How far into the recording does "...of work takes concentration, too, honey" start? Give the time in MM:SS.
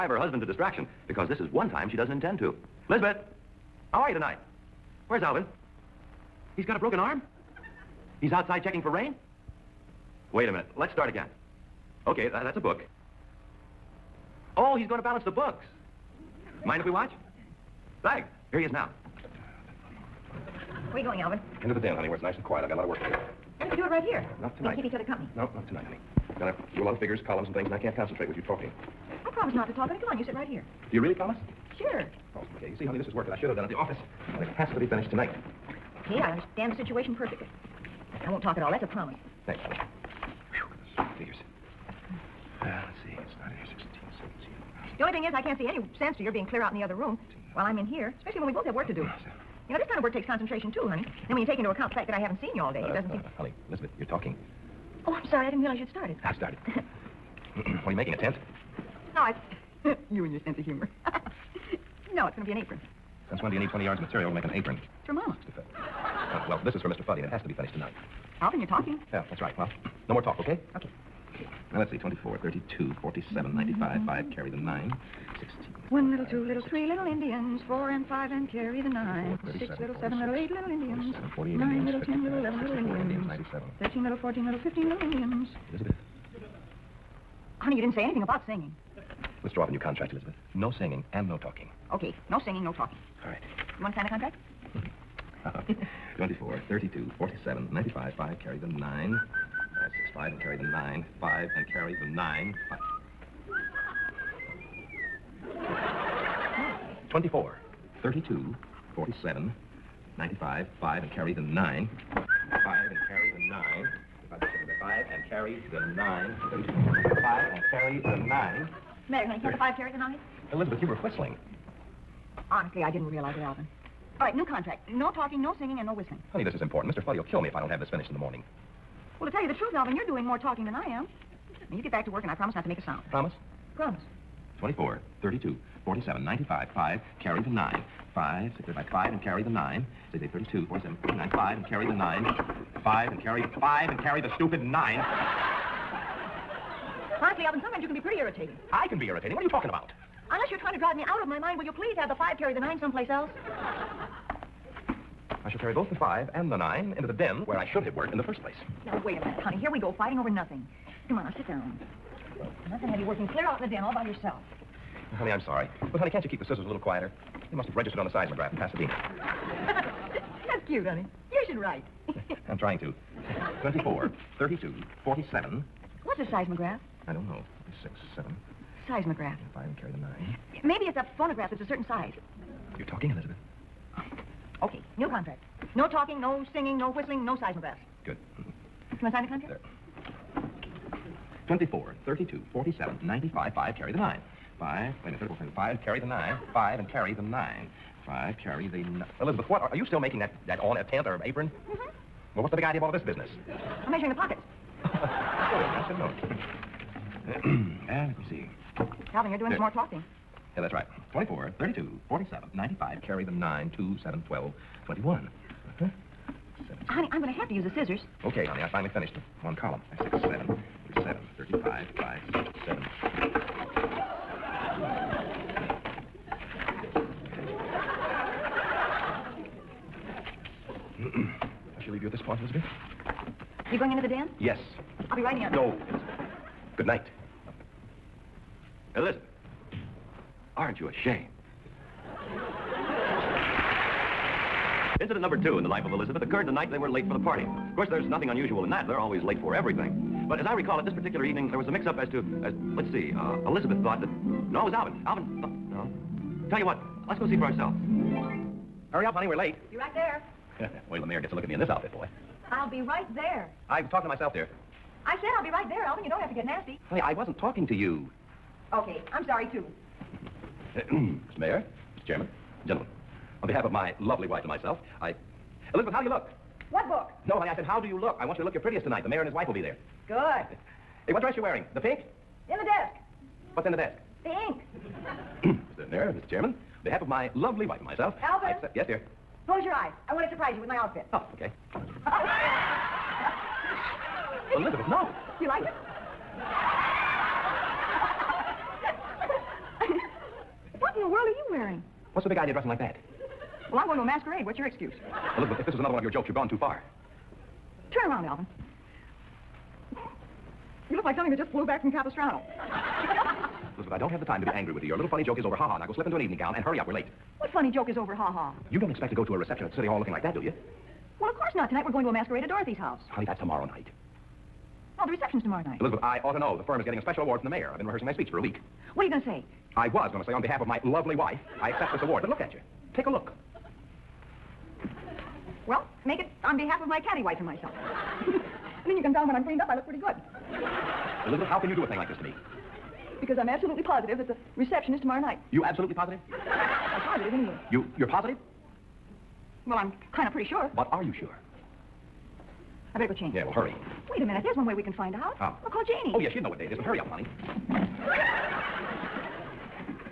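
00:49.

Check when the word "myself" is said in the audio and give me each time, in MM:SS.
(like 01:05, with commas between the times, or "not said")
04:24, 04:34, 04:47, 05:37.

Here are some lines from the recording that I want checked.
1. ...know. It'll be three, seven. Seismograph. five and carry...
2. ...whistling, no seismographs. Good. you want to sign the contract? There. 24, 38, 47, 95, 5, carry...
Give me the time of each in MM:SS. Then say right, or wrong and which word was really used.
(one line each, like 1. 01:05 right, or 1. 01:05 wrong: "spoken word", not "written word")
1. 02:57 wrong: "six", not "three"
2. 03:06 wrong: "32", not "38".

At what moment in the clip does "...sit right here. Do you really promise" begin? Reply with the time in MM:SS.
00:30.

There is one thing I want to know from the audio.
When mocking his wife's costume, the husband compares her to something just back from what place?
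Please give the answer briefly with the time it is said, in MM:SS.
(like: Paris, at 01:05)
Capistrano, at 05:11.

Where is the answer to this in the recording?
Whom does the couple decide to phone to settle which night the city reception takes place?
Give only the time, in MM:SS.
05:55.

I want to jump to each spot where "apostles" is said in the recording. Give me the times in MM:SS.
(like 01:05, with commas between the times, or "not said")
not said.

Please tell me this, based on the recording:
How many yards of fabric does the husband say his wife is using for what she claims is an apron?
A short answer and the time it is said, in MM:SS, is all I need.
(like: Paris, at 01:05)
20, at 01:03.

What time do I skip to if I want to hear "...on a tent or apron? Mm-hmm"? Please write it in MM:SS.
03:20.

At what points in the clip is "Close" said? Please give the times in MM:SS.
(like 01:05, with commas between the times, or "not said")
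04:49.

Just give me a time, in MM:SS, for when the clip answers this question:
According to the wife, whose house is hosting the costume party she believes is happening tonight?
05:22.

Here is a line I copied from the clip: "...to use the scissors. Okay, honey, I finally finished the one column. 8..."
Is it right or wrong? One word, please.
wrong.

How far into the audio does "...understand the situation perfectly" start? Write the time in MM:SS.
00:36.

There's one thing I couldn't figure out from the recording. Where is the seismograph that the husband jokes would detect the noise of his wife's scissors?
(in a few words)
Pasadena.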